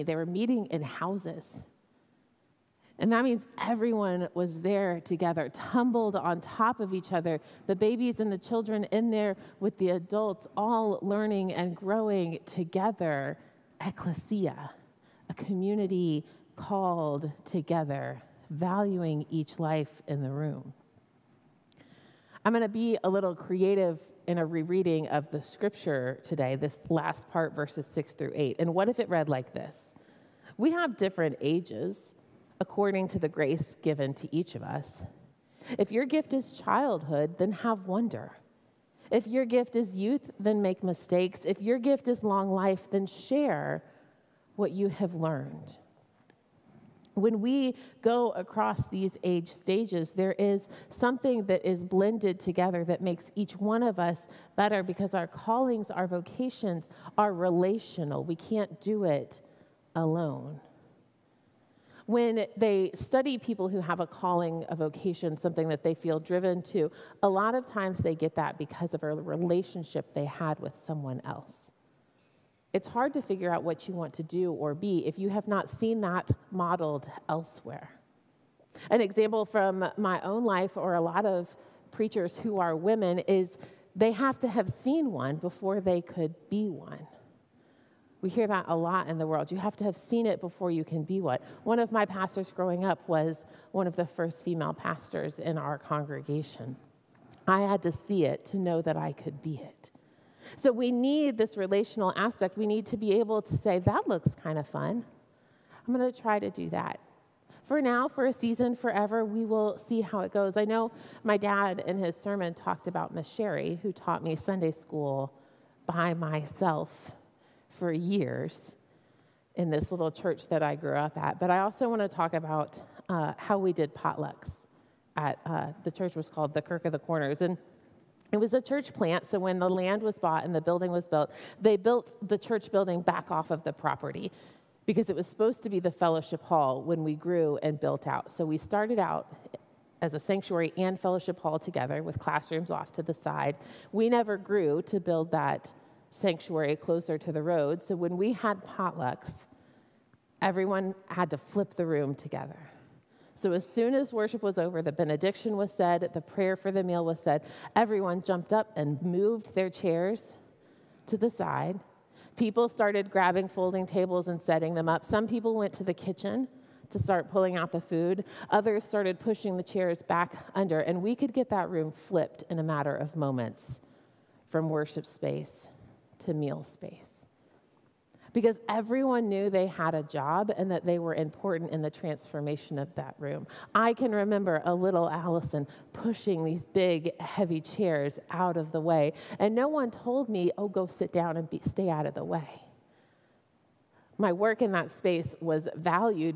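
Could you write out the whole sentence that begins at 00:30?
We have different ages according to the grace given to each of us.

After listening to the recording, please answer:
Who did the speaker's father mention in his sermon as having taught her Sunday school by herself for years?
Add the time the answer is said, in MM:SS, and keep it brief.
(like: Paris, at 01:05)
Miss Sherry, at 01:53.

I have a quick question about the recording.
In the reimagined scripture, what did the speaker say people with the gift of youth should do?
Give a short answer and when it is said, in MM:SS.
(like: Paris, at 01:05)
make mistakes, at 00:40.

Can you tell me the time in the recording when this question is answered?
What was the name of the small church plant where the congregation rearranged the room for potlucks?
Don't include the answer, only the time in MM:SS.
02:06.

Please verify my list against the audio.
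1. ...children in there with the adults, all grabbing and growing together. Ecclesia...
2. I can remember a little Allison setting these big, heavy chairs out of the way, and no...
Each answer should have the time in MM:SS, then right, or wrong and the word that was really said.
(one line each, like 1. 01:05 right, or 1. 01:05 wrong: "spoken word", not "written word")
1. 00:08 wrong: "learning", not "grabbing"
2. 03:03 wrong: "pushing", not "setting".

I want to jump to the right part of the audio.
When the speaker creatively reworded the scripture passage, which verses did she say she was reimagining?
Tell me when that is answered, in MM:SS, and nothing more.
00:27.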